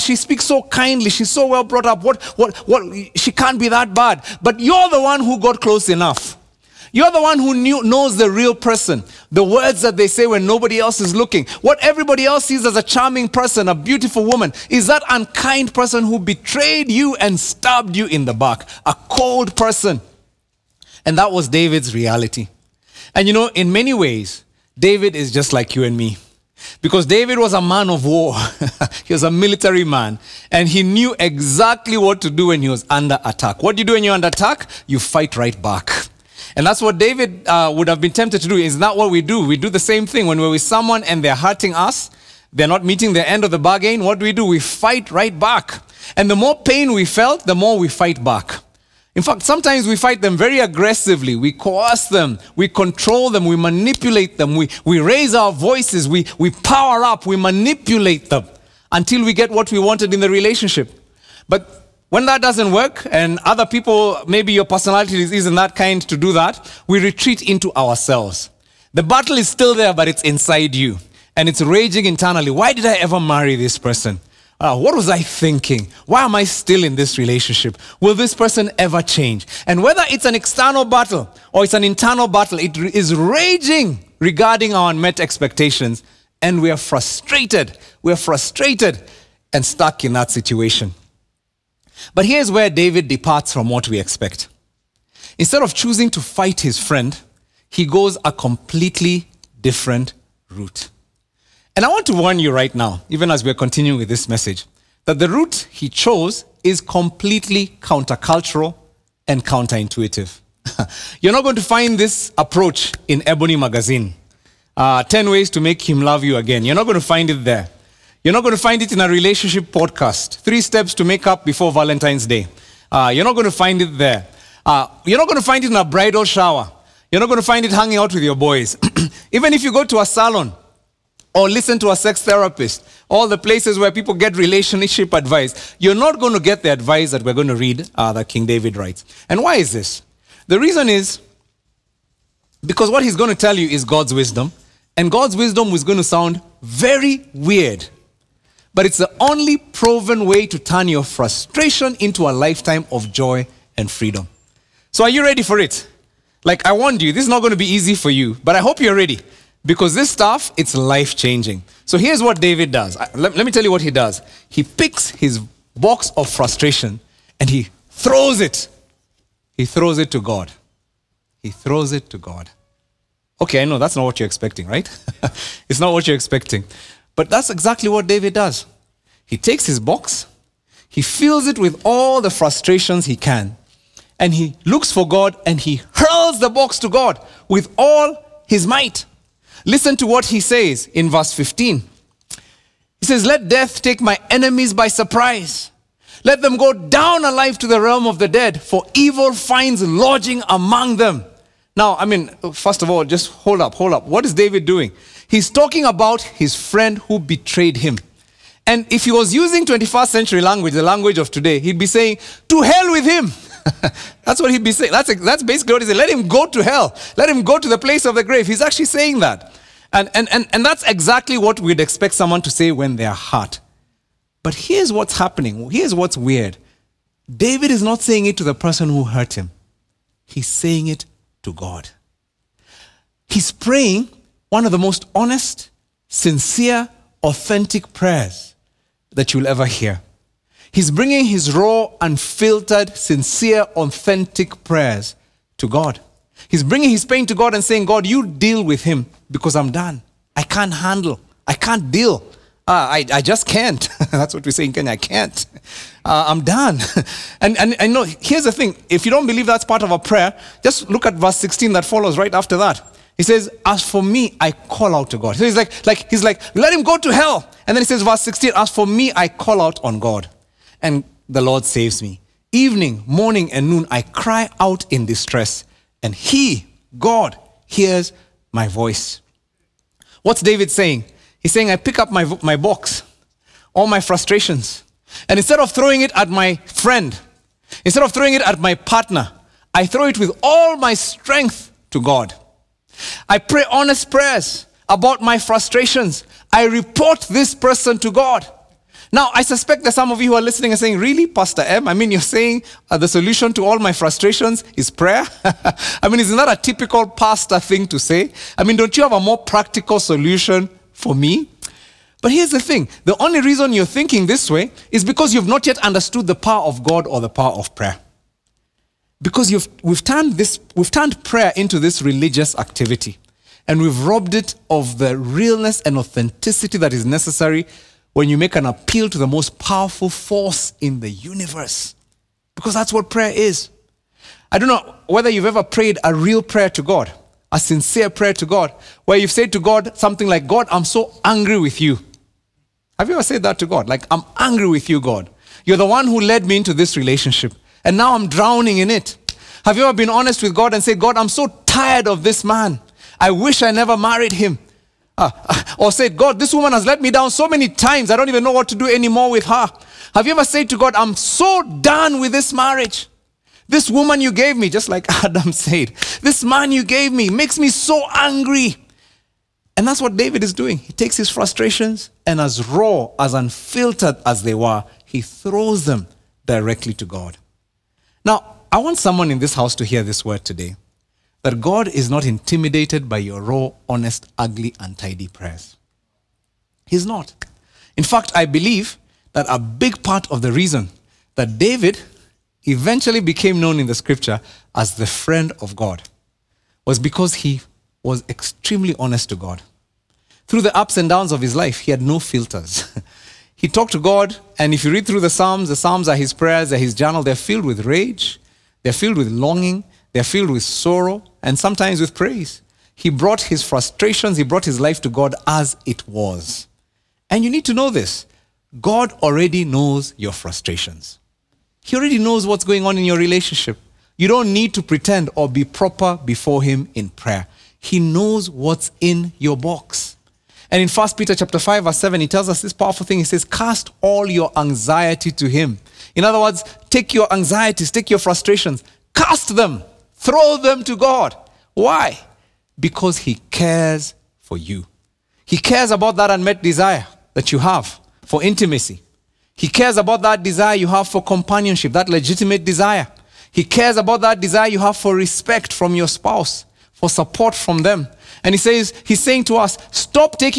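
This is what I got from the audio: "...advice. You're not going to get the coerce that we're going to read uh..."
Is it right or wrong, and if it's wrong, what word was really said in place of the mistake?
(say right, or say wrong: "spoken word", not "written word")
wrong: "advice", not "coerce".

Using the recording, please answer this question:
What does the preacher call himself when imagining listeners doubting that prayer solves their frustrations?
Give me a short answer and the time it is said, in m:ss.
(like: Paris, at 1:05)
Pastor M, at 5:01.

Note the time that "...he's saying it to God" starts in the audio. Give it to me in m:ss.
3:50.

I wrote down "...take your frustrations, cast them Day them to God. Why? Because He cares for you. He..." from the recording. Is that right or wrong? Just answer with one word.
wrong.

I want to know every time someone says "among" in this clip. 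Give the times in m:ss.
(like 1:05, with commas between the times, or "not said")
3:20.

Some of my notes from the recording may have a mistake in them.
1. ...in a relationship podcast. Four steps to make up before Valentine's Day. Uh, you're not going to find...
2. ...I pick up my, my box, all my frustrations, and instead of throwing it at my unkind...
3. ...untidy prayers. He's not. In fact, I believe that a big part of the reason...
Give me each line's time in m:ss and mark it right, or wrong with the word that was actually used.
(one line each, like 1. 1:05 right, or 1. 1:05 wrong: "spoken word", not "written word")
1. 1:58 wrong: "Three", not "Four"
2. 4:41 wrong: "friend", not "unkind"
3. 6:24 right.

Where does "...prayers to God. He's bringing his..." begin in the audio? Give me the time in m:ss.
4:04.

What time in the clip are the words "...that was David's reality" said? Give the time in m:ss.
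0:21.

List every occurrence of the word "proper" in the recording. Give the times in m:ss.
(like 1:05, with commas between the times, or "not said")
7:05.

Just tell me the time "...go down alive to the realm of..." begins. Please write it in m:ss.
3:16.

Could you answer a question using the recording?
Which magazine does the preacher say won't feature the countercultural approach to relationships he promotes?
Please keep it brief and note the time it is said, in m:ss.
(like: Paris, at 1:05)
Ebony, at 1:53.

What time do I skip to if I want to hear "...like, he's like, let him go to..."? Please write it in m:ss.
4:25.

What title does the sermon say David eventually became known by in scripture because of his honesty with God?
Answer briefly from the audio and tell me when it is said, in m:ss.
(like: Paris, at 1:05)
the friend of God, at 6:34.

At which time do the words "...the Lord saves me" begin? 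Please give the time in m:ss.
4:31.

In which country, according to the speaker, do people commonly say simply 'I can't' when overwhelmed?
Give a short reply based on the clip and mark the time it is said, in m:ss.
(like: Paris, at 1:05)
Kenya, at 4:14.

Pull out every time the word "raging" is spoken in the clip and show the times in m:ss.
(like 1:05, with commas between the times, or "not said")
1:11, 1:23.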